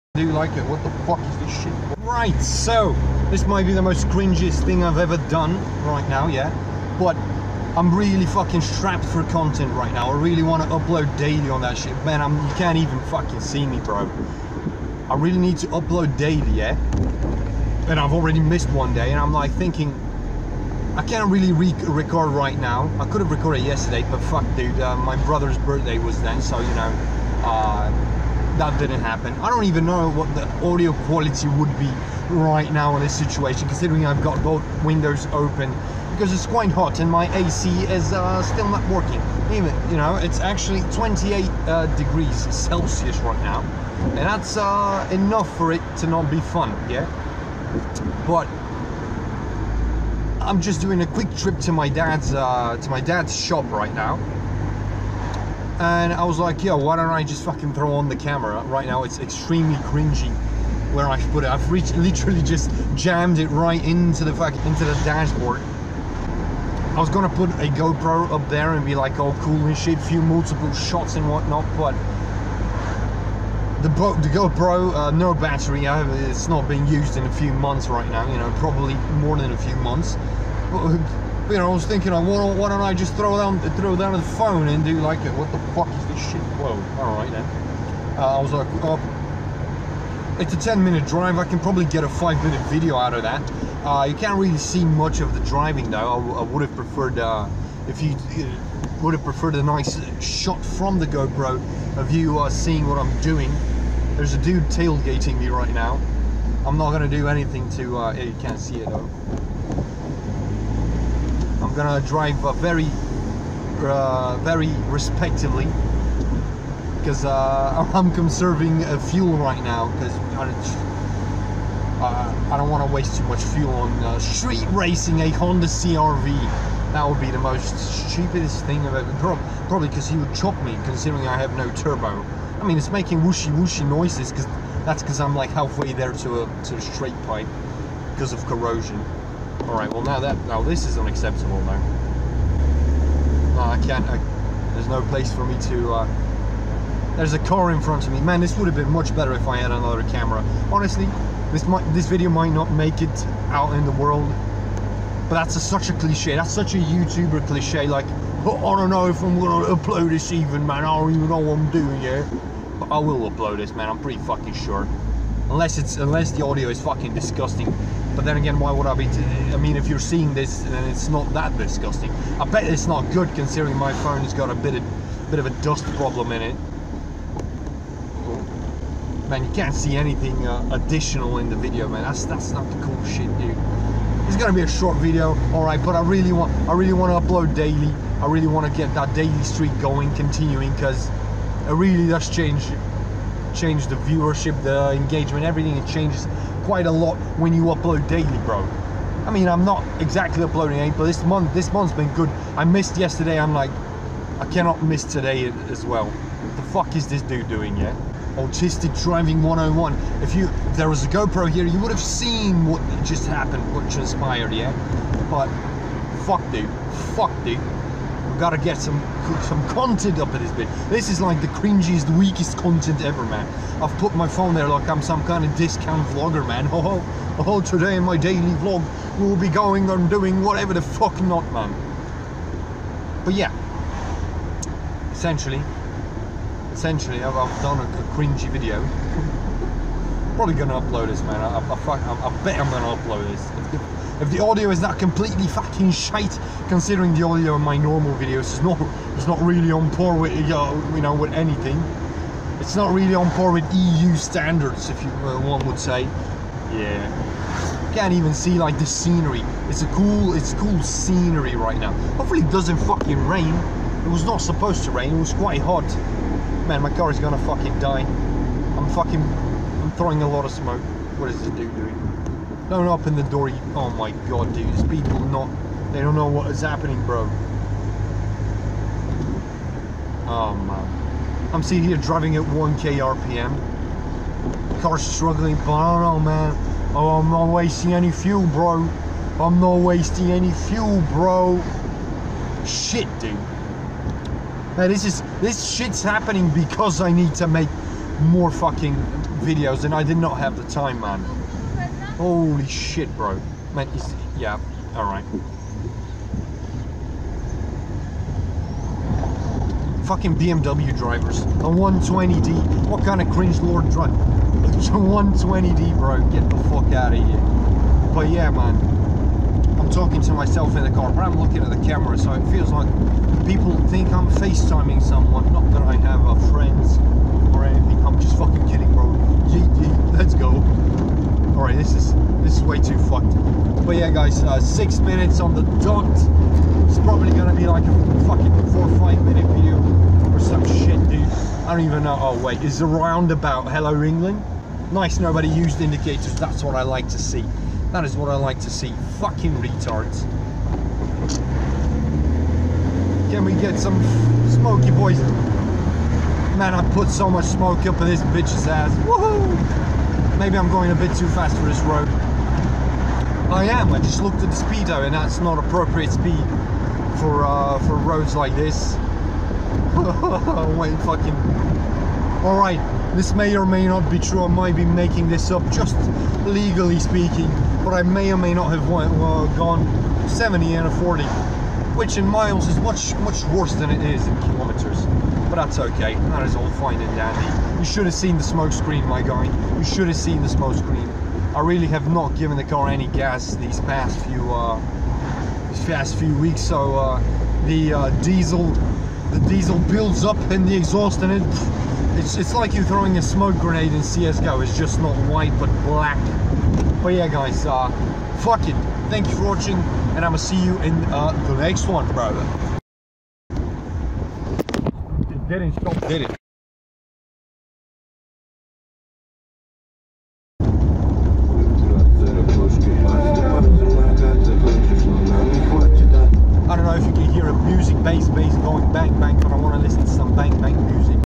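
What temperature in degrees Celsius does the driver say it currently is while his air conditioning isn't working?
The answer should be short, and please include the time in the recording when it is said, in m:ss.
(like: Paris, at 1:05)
28, at 0:40.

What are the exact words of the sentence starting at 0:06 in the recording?
But I'm really fucking strapped for content right now.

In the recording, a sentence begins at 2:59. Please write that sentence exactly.
Man, you can't see anything uh, additional in the video, man.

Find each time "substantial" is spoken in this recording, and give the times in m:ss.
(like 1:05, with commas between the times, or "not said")
not said.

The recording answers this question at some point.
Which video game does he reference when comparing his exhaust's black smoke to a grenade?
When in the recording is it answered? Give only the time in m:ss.
6:44.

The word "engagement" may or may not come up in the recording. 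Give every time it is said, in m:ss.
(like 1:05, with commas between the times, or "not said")
3:14.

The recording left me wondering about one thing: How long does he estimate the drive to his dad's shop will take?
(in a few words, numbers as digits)
10 minutes.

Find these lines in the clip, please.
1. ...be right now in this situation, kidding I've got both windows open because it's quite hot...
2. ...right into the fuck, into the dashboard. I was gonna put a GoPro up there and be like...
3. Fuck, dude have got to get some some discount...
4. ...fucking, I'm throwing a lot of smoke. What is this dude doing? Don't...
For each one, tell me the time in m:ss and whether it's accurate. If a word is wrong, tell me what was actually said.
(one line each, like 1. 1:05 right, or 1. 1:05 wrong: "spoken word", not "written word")
1. 0:31 wrong: "considering", not "kidding"
2. 1:03 right
3. 3:37 wrong: "content", not "discount"
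4. 4:28 right.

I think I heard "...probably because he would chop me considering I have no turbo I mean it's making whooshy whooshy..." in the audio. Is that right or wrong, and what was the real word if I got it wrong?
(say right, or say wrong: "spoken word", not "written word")
right.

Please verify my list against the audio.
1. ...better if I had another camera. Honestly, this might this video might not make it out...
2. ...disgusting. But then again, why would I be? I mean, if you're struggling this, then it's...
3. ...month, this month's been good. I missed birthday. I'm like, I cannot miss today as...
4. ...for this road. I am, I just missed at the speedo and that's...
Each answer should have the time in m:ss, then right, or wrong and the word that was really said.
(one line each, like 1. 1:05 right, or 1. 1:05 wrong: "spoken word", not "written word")
1. 2:29 right
2. 2:47 wrong: "seeing", not "struggling"
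3. 3:21 wrong: "yesterday", not "birthday"
4. 6:01 wrong: "looked", not "missed".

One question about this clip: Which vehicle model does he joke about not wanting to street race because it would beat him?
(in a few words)
Honda CRV.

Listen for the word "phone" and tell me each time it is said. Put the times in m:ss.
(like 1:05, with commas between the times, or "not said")
1:24, 2:54, 3:44.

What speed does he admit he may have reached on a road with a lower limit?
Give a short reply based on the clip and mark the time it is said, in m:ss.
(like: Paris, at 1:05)
70, at 6:20.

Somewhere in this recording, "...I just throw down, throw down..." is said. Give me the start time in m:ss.
1:22.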